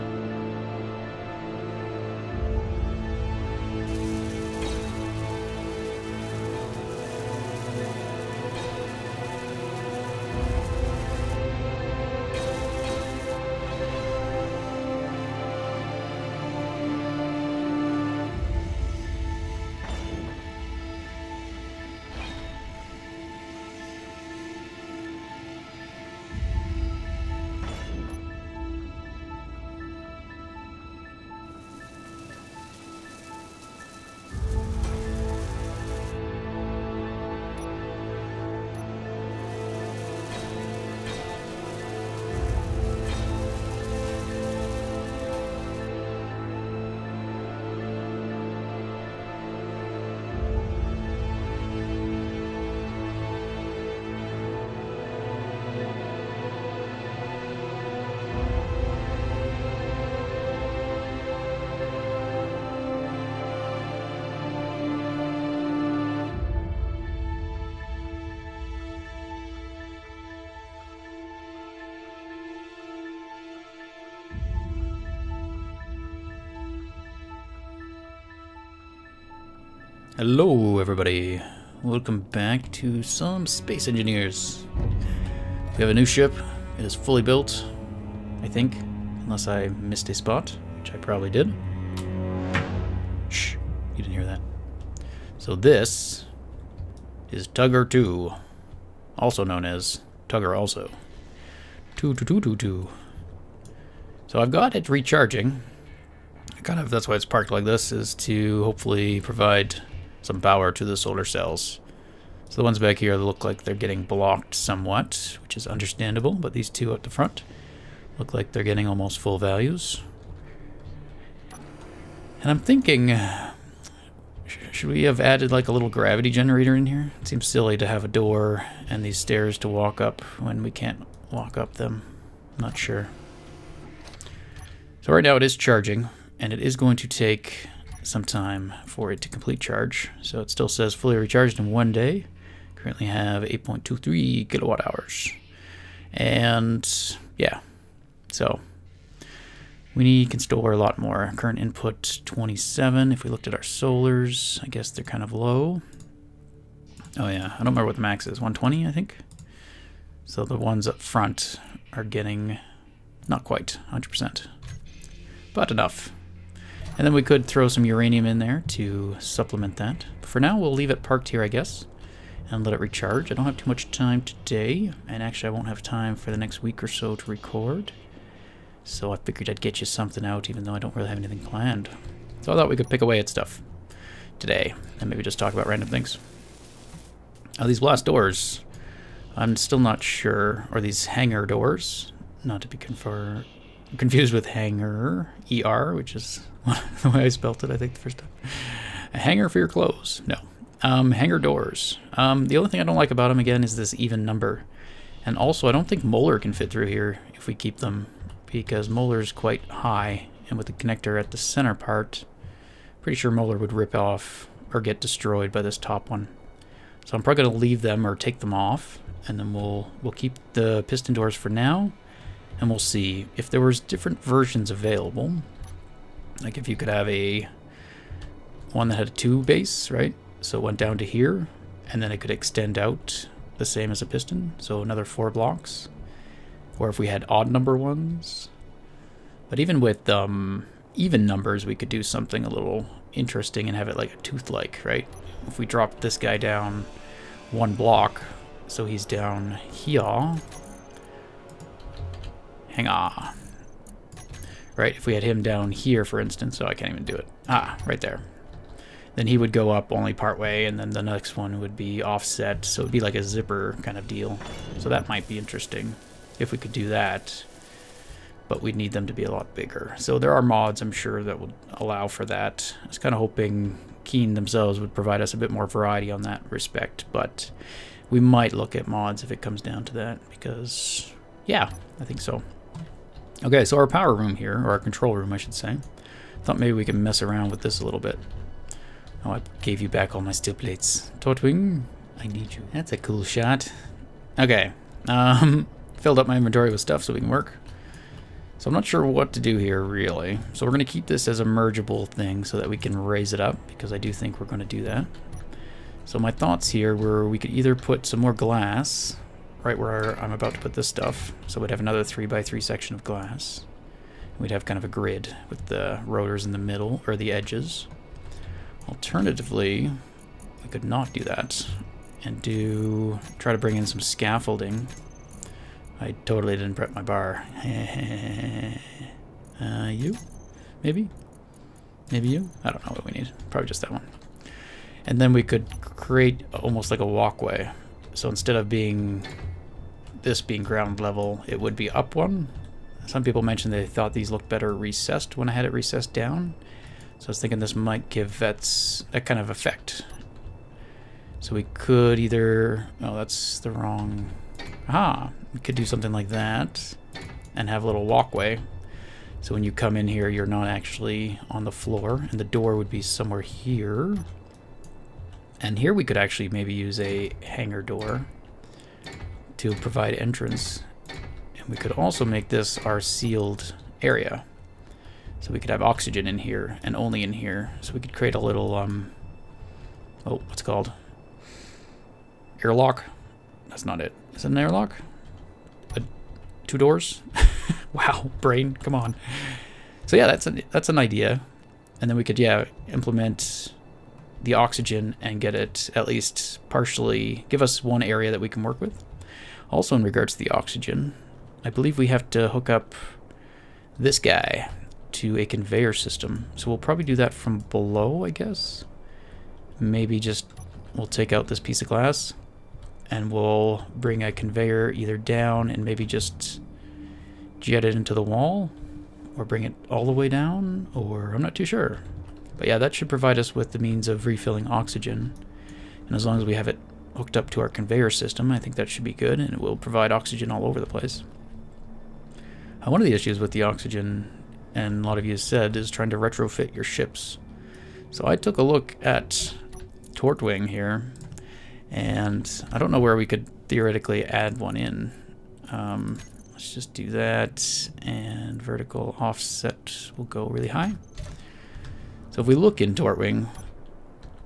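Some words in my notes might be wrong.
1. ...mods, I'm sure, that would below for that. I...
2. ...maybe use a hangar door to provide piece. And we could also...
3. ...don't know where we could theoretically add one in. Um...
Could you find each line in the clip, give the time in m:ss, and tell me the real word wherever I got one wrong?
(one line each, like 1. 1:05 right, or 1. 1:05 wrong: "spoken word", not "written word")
1. 4:30 wrong: "allow", not "below"
2. 6:06 wrong: "entrance", not "piece"
3. 7:22 right.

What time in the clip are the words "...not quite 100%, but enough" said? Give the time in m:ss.
2:43.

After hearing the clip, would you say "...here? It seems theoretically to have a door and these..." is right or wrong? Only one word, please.
wrong.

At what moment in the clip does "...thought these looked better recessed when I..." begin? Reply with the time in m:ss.
5:43.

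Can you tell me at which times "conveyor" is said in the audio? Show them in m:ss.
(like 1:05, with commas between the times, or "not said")
6:45, 6:54, 7:07.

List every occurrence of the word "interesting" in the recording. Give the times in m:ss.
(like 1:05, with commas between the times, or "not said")
4:03, 4:25.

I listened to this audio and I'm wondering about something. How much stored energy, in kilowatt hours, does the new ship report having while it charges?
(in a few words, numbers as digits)
8.23.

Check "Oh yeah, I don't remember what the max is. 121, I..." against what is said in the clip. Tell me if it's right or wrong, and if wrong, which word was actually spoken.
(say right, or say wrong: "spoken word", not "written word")
wrong: "120", not "121".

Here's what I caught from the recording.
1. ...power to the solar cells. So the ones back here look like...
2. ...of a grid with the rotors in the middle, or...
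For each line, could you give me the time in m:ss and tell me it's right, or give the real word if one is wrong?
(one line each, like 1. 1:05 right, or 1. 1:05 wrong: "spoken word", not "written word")
1. 1:50 right
2. 5:14 right.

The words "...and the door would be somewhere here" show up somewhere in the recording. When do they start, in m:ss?
6:02.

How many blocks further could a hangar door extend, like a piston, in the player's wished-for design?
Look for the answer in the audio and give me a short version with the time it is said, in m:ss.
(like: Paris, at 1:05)
4, at 3:54.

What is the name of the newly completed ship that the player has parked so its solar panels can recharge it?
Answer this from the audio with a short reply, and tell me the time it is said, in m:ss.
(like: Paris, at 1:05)
Tugger 2, at 1:37.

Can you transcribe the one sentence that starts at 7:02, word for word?
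But yeah, that should provide us with the means of refilling oxygen.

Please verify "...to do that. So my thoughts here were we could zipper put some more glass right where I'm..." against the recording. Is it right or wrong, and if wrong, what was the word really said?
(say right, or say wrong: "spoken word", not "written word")
wrong: "either", not "zipper".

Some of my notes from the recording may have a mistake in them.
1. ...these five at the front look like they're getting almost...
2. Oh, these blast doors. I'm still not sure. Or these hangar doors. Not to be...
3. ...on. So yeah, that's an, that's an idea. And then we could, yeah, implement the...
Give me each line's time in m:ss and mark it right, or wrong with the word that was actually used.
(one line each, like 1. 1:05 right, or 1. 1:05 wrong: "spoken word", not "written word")
1. 1:56 wrong: "two", not "five"
2. 3:07 right
3. 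6:28 right.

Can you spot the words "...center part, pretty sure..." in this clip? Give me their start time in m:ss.
3:31.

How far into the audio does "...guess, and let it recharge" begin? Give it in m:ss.
2:51.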